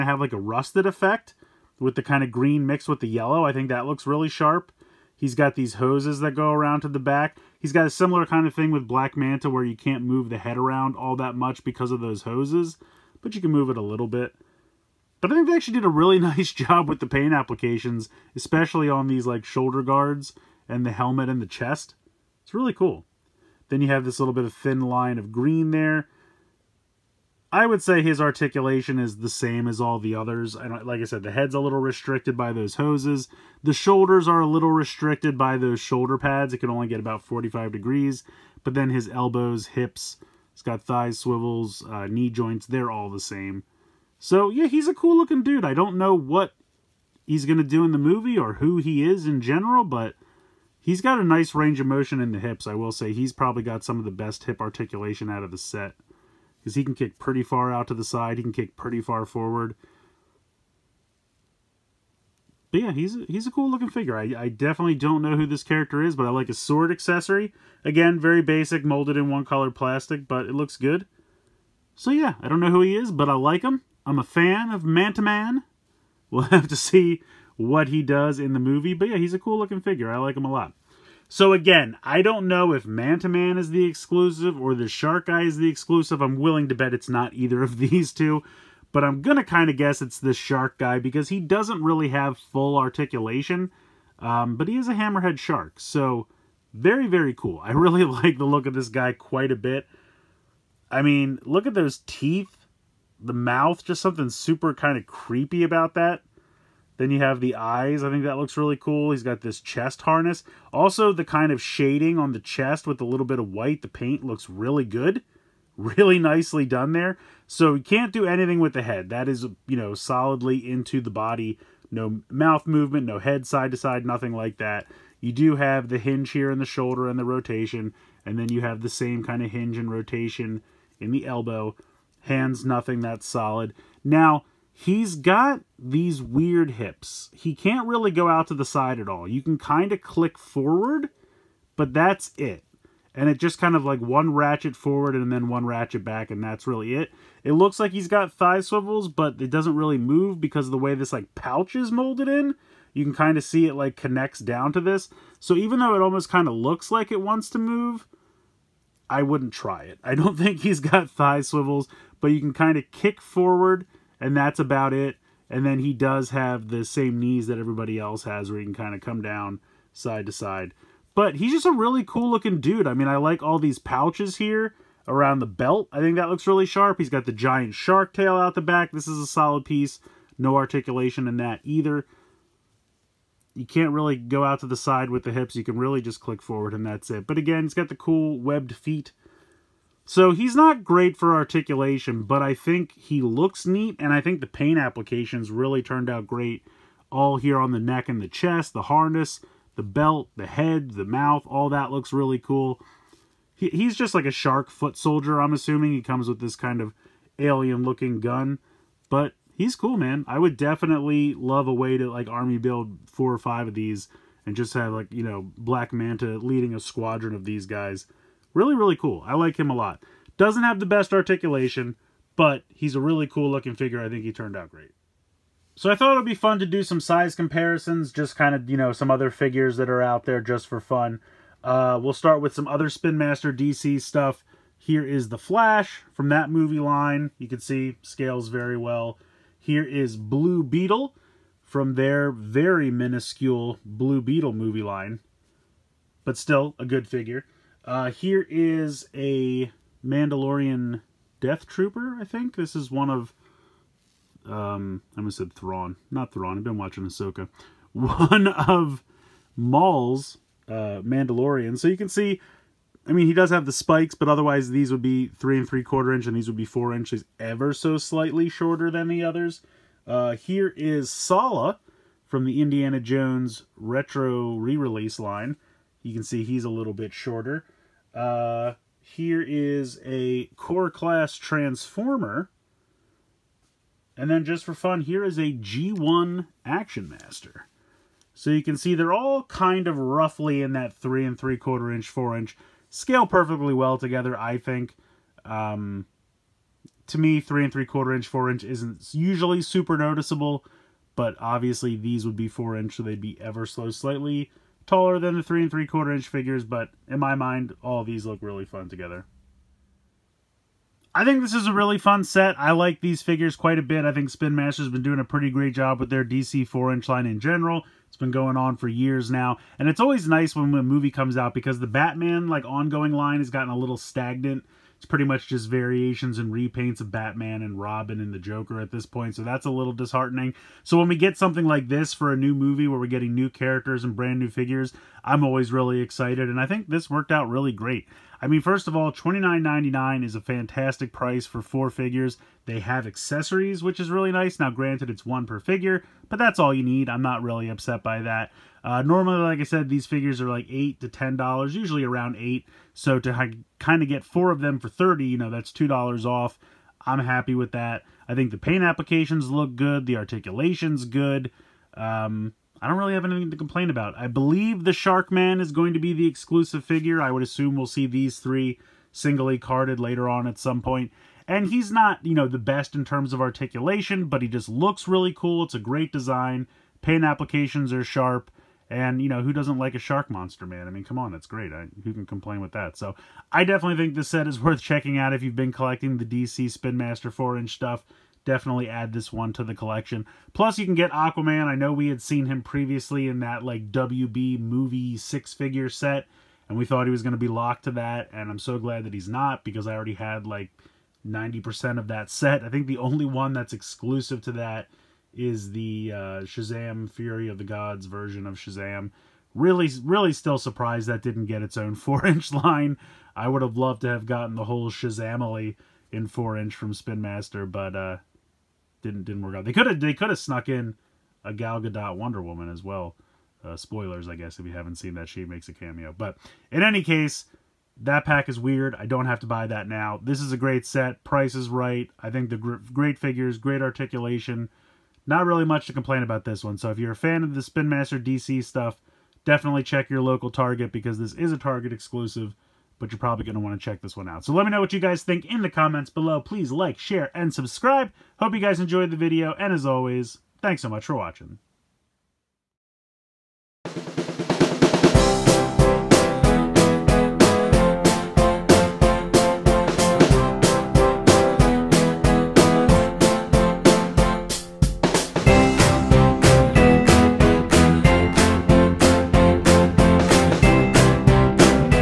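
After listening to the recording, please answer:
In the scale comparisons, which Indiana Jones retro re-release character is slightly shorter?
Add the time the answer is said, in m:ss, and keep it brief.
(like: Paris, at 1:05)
Sallah, at 4:31.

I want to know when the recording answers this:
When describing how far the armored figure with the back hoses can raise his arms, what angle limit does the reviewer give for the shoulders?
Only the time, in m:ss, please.
0:37.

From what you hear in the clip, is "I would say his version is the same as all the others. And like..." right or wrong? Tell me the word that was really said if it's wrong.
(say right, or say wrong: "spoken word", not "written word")
wrong: "articulation", not "version".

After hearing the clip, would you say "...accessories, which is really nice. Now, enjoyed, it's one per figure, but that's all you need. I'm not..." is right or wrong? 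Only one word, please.
wrong.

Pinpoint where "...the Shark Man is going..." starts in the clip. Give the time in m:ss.
6:04.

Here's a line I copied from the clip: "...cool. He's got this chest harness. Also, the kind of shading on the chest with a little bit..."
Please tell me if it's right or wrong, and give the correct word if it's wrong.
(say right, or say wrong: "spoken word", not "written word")
right.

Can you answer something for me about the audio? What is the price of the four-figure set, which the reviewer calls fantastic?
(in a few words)
$29.99.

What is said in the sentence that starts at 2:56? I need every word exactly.
He's got the giant shark tail out the back.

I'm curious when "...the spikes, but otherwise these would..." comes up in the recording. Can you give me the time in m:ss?
4:23.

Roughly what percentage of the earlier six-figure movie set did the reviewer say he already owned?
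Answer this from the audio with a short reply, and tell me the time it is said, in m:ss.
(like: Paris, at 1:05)
90%, at 6:41.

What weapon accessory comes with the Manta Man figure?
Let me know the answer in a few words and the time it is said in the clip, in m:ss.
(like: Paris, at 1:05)
Sword, at 1:06.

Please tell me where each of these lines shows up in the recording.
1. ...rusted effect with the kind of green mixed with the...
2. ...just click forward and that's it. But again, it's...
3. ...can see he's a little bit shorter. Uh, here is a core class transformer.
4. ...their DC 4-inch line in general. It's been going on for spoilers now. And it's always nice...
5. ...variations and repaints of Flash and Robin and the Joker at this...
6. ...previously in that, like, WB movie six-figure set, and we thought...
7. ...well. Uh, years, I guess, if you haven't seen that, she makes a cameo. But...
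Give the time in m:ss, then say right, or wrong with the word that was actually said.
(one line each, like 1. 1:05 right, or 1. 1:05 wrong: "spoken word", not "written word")
1. 0:00 right
2. 3:06 right
3. 4:36 right
4. 5:16 wrong: "years", not "spoilers"
5. 5:25 wrong: "Batman", not "Flash"
6. 6:32 right
7. 7:02 wrong: "spoilers", not "years".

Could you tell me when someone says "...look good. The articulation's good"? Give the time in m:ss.
5:59.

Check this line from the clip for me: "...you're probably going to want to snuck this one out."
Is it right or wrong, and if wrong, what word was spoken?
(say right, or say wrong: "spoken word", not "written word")
wrong: "check", not "snuck".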